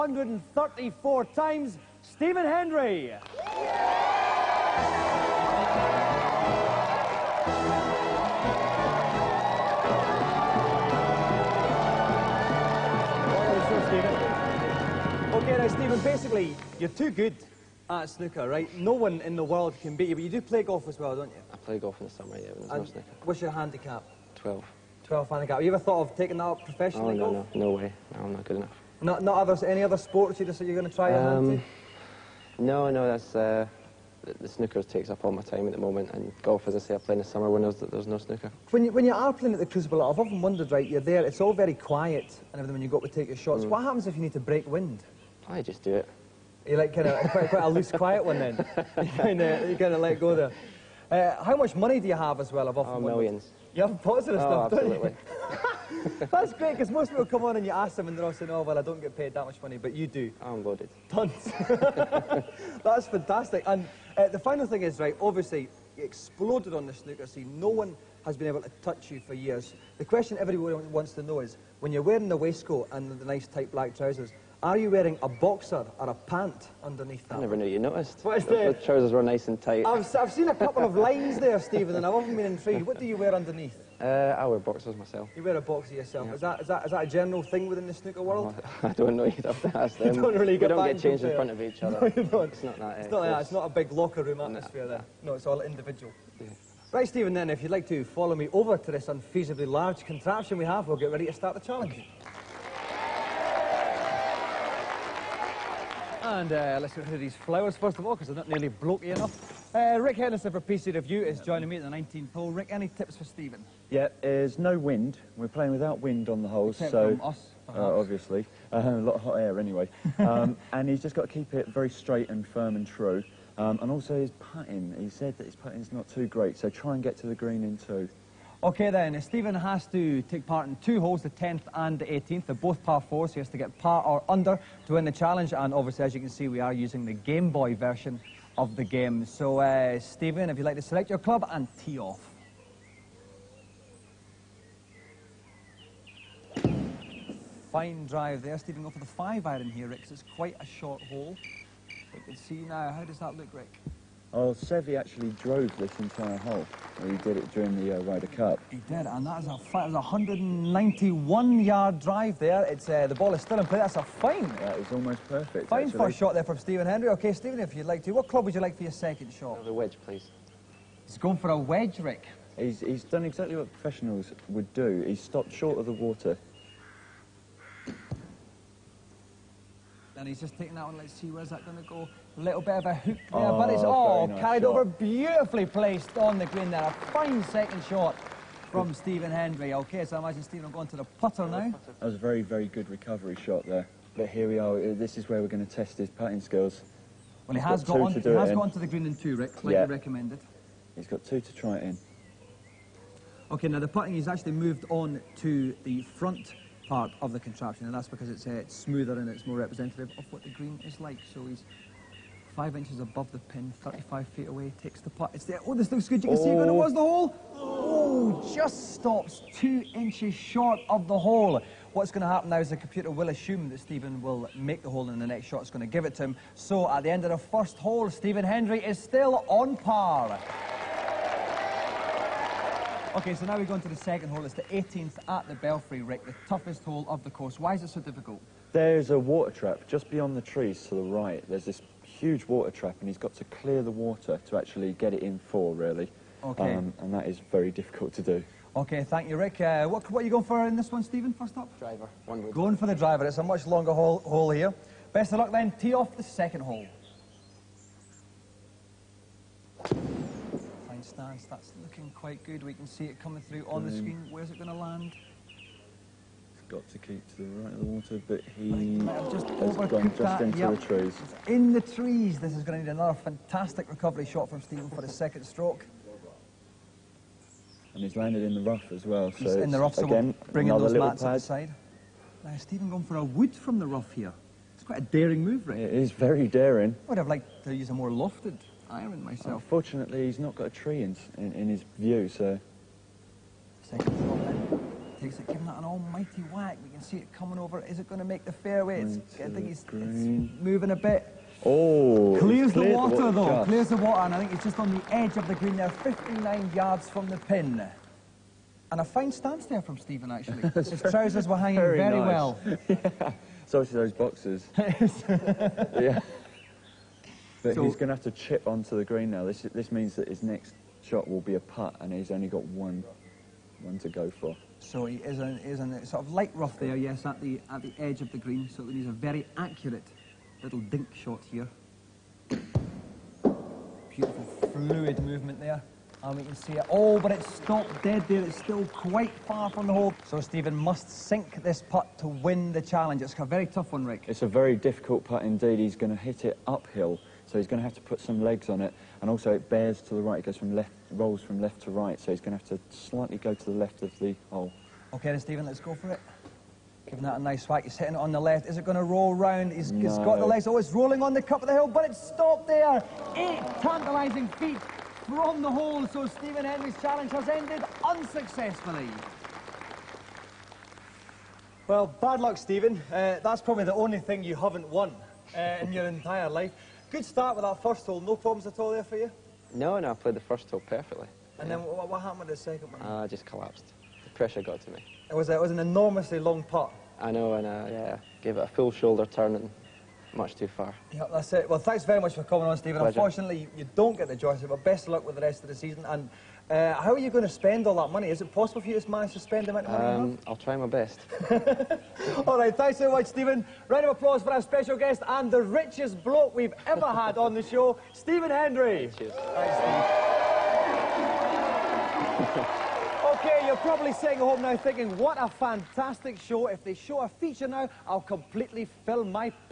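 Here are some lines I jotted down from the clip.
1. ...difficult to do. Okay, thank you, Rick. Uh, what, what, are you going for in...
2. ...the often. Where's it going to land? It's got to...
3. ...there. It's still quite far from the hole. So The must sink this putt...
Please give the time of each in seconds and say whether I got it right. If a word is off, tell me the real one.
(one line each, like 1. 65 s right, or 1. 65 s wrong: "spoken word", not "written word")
1. 247 s right
2. 263 s wrong: "screen", not "often"
3. 338 s wrong: "Stephen", not "The".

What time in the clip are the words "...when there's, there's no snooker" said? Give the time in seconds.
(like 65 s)
37 s.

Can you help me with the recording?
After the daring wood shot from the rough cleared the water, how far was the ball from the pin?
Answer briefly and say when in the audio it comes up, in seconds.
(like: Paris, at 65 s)
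59 yards, at 305 s.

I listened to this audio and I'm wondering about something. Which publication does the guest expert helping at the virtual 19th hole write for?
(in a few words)
PC Review.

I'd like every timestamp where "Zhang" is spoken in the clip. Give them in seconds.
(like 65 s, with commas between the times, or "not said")
not said.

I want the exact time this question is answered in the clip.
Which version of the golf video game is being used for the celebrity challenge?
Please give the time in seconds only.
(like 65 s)
137 s.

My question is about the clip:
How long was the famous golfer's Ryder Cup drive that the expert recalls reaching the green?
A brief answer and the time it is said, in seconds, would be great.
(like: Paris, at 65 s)
191 yards, at 160 s.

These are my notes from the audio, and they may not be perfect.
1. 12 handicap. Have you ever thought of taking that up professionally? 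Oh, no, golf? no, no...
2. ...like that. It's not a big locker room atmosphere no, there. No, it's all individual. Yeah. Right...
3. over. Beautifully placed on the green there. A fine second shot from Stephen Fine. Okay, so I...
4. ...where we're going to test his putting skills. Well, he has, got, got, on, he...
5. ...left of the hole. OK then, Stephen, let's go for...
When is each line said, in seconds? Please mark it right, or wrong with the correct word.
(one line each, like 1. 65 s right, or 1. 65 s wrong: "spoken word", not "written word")
1. 25 s right
2. 93 s right
3. 184 s wrong: "Hendry", not "Fine"
4. 195 s right
5. 353 s right.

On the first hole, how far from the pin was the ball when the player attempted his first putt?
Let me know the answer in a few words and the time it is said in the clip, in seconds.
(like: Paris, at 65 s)
35 feet, at 213 s.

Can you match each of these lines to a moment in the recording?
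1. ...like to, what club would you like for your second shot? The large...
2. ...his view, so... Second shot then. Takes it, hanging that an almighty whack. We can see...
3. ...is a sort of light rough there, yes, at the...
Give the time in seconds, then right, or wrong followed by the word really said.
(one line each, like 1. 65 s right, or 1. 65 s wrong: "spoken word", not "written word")
1. 167 s wrong: "wedge", not "large"
2. 291 s wrong: "giving", not "hanging"
3. 325 s right.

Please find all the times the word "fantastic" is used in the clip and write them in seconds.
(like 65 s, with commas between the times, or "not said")
63 s, 273 s, 415 s.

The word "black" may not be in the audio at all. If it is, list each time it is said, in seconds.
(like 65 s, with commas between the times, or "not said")
73 s.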